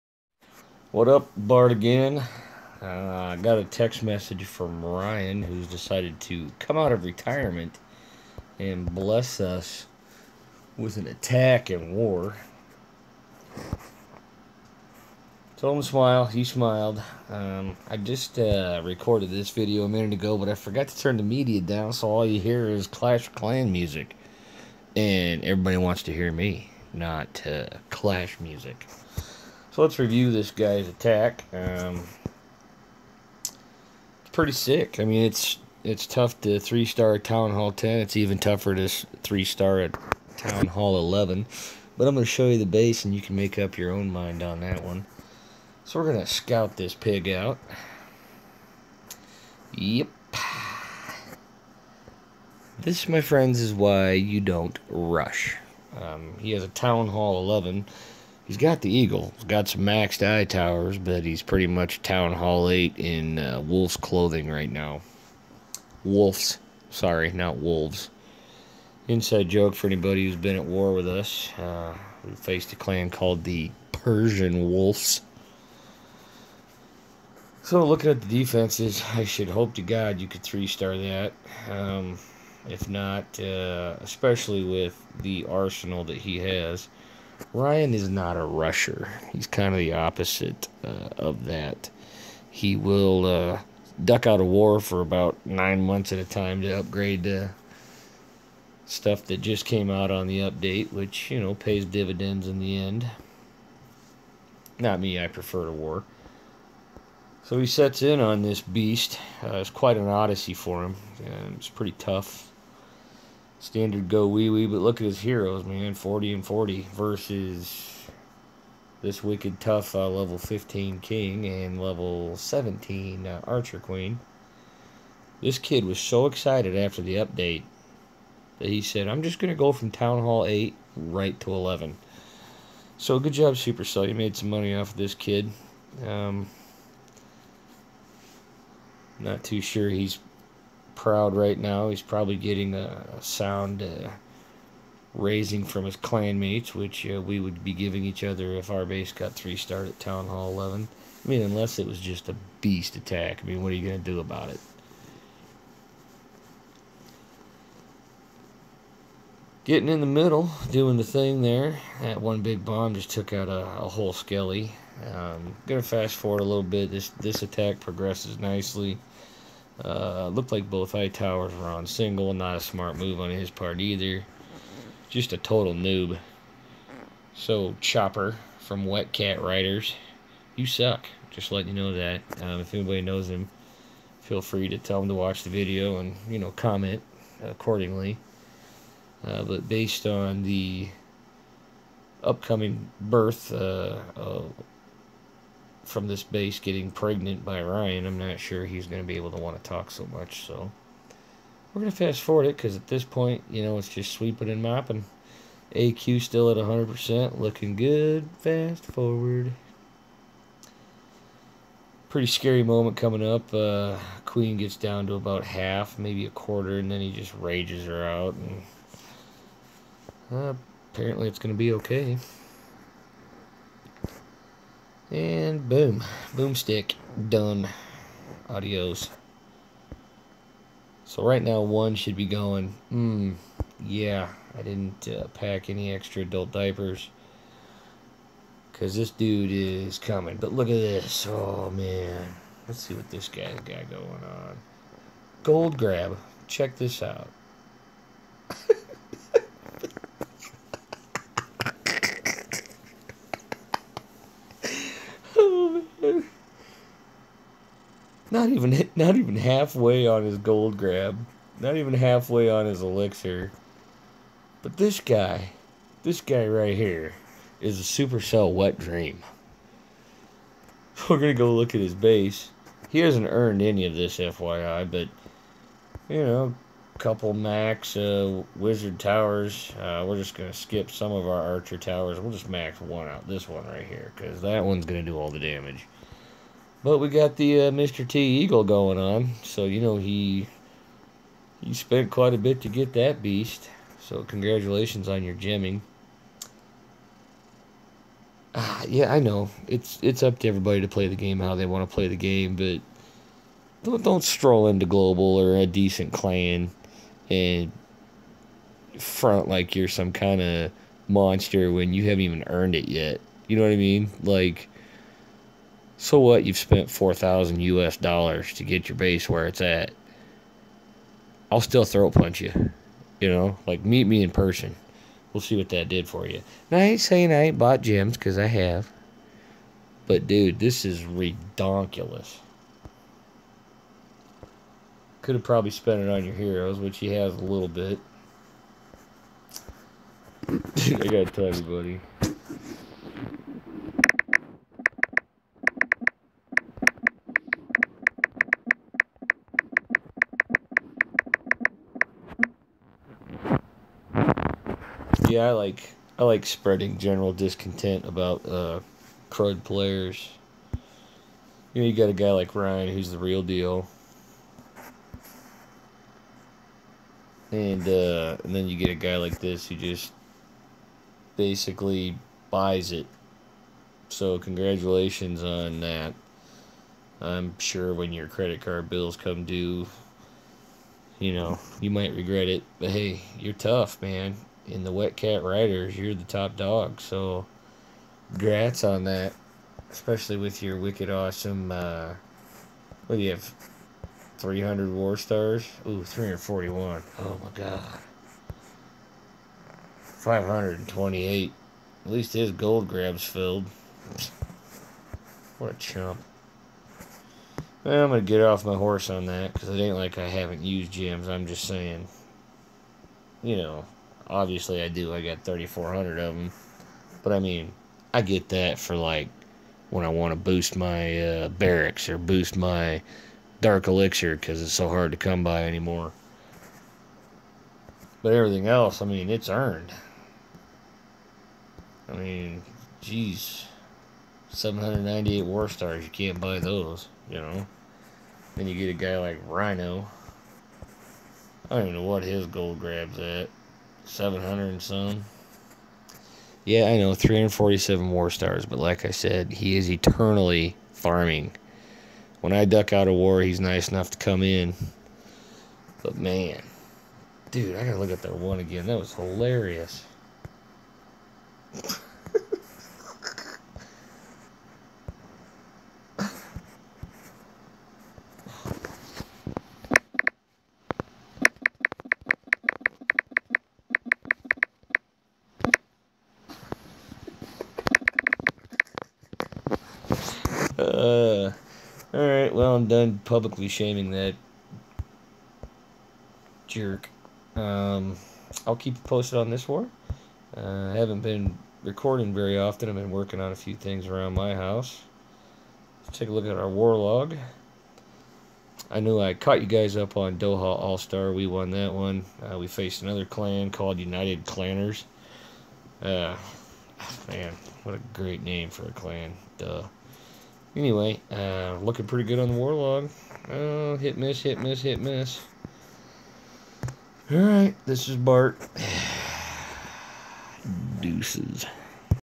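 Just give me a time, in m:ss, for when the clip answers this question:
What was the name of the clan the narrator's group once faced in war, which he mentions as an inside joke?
1:13.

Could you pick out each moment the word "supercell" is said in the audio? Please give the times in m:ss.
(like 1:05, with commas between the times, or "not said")
2:13, 4:27.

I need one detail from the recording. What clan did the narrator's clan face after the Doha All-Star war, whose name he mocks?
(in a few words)
United Clanners.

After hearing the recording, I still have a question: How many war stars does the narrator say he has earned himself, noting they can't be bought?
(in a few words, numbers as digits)
798.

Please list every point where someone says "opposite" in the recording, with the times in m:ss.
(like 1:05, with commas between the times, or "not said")
1:29.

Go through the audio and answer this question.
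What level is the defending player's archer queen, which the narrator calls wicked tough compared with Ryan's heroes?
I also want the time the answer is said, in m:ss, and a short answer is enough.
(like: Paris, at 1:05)
17, at 2:01.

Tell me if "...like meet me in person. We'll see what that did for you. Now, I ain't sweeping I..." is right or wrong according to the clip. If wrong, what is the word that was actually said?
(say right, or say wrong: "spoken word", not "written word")
wrong: "saying", not "sweeping".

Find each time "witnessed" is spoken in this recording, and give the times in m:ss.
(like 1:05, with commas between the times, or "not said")
not said.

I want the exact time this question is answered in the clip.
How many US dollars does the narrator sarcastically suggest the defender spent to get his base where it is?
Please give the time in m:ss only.
5:16.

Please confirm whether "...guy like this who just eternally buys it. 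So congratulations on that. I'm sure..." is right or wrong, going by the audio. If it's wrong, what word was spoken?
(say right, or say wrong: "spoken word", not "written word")
wrong: "basically", not "eternally".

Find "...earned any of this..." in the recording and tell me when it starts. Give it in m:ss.
4:33.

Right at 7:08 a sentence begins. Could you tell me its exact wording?
But everything else, I mean, it's earned.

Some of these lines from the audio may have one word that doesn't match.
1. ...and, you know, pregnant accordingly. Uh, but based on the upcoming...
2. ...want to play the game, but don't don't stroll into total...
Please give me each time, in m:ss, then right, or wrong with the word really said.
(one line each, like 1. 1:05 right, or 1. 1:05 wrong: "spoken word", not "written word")
1. 3:05 wrong: "comment", not "pregnant"
2. 5:01 wrong: "global", not "total".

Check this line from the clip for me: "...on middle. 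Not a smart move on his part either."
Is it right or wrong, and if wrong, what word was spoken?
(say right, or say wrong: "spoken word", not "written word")
wrong: "single", not "middle".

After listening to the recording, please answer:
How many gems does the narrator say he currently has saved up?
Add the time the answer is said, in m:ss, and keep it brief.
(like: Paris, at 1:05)
3,400, at 6:55.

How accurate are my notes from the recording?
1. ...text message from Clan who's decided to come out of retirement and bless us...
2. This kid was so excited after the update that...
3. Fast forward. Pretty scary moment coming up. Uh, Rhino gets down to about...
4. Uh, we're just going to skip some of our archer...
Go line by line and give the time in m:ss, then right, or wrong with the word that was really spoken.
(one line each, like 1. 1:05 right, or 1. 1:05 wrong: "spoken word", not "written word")
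1. 0:03 wrong: "Ryan", not "Clan"
2. 2:05 right
3. 3:28 wrong: "Queen", not "Rhino"
4. 4:39 right.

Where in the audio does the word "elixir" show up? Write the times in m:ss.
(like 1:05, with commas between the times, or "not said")
4:22, 7:03.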